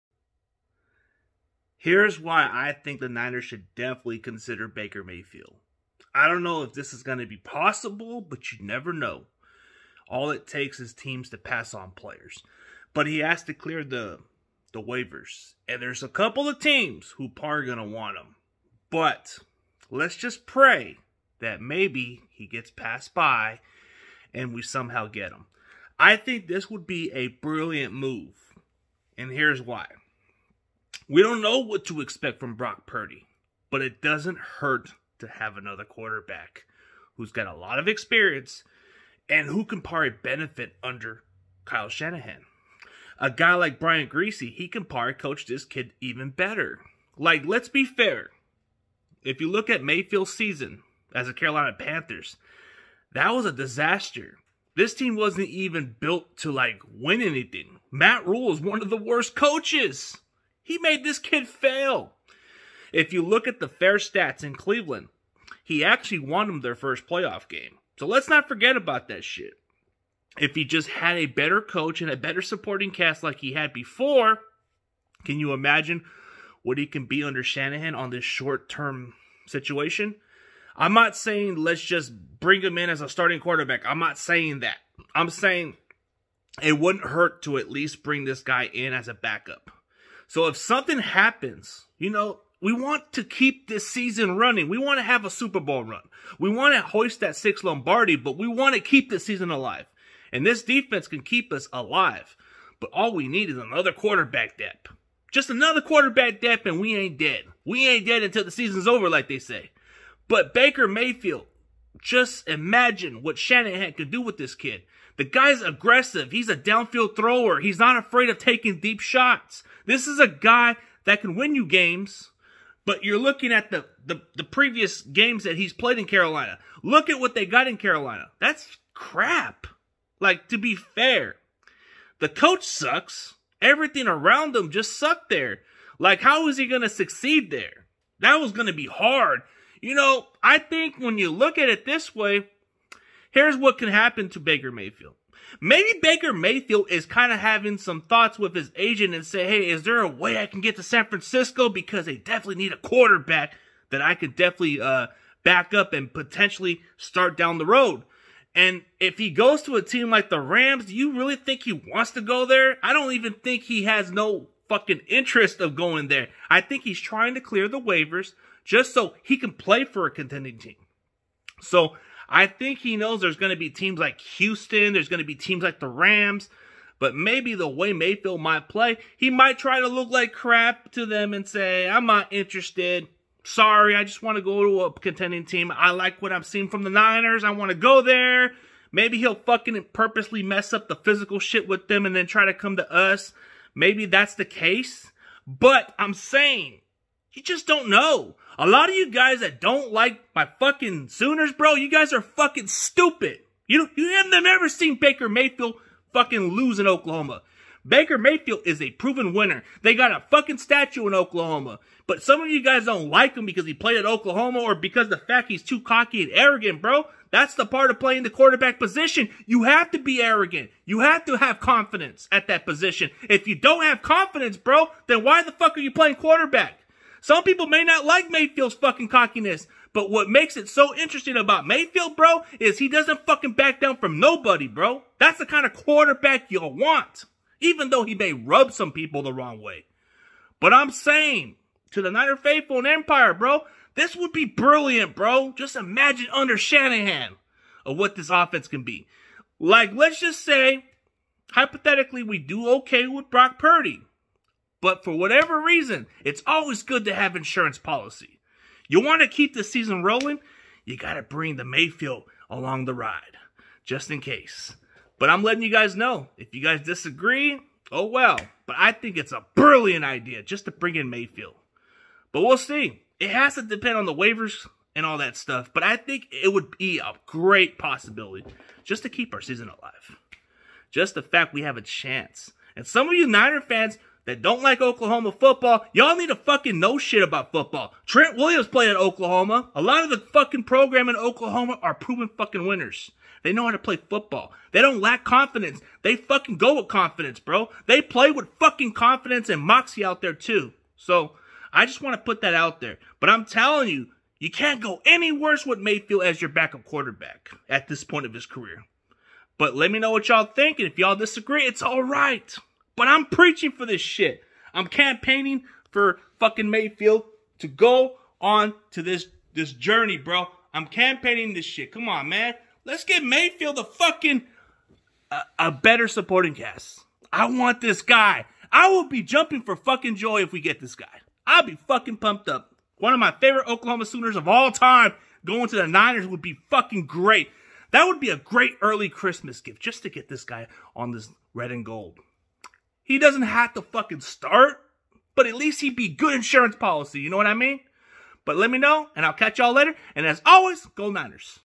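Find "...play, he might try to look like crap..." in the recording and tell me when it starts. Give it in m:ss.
2:58.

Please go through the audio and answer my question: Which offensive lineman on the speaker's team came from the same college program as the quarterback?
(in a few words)
Trent Williams.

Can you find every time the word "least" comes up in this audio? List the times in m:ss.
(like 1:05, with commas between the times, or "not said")
1:27, 5:45.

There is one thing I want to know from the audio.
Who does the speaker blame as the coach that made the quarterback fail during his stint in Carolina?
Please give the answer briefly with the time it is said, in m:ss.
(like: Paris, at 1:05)
Matt Rhule, at 0:57.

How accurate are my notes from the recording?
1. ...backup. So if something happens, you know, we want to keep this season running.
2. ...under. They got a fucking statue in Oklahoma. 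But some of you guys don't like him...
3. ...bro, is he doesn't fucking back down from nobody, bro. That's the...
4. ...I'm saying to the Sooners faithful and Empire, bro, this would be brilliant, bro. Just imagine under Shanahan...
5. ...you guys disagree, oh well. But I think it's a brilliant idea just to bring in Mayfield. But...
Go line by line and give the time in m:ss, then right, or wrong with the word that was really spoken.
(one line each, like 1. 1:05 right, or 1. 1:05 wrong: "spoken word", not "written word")
1. 1:29 right
2. 3:29 wrong: "winner", not "under"
3. 3:52 right
4. 4:00 wrong: "Niner", not "Sooners"
5. 4:26 right.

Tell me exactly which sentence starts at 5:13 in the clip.
When I'm preaching for this shit, I'm campaigning for fucking Mayfield to go on to this this journey, bro.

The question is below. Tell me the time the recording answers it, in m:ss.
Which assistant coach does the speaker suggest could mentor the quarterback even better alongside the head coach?
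0:43.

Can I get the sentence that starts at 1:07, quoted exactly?
So let's not forget about that shit.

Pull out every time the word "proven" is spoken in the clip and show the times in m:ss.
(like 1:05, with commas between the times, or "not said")
3:28, 4:51.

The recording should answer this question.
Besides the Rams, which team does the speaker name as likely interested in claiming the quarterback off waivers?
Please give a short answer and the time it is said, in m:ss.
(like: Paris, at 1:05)
Houston, at 2:54.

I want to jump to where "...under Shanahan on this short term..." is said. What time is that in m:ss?
1:17.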